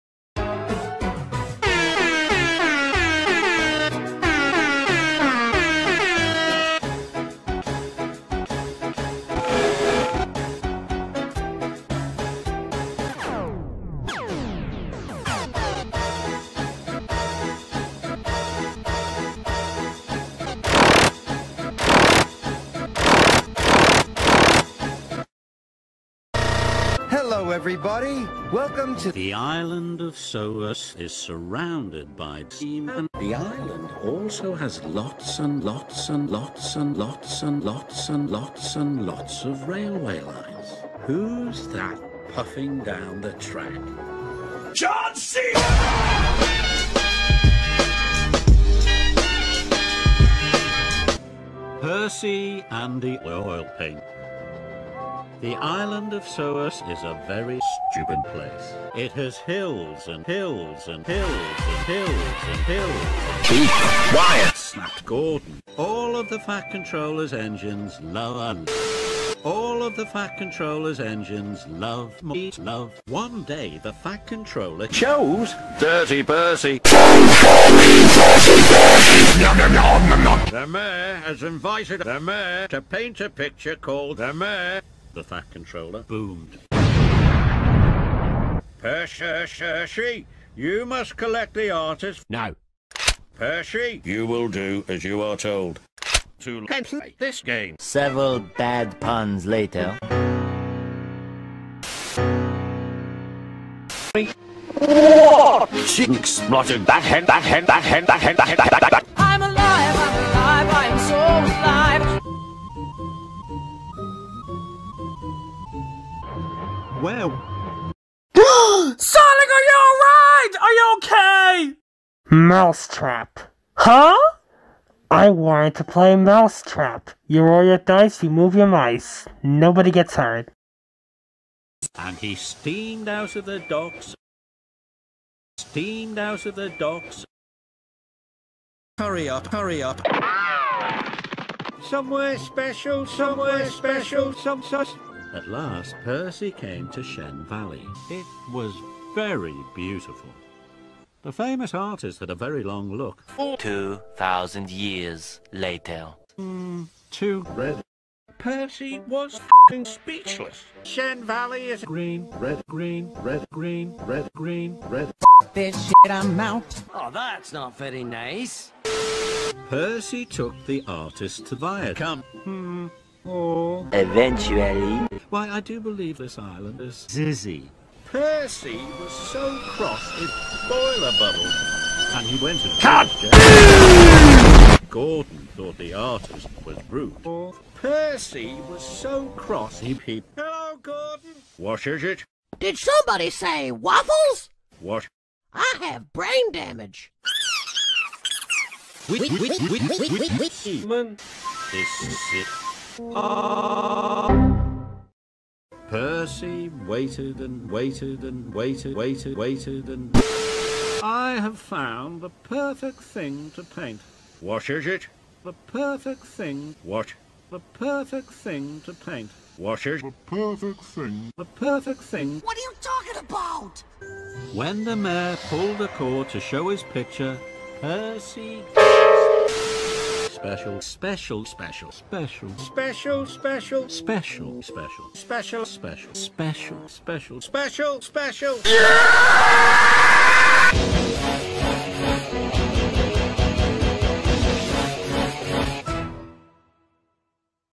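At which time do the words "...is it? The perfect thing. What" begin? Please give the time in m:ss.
3:34.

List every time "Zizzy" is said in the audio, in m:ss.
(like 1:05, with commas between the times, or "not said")
2:57.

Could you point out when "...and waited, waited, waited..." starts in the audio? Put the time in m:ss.
3:28.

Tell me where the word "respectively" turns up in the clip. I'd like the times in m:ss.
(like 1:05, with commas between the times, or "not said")
not said.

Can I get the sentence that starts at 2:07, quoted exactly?
You roll your dice, you move your mice.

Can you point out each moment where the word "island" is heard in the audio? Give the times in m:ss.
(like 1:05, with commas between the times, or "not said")
0:29, 0:33, 0:55, 2:56.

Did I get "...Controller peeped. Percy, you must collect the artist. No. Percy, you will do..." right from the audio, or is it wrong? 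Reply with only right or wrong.
wrong.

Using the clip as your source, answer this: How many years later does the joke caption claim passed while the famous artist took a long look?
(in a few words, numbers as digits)
2,000.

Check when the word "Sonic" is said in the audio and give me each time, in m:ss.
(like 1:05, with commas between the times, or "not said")
1:58.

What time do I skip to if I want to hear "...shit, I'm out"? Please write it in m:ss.
2:45.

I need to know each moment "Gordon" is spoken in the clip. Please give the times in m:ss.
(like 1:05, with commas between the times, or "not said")
1:05, 3:04, 3:10.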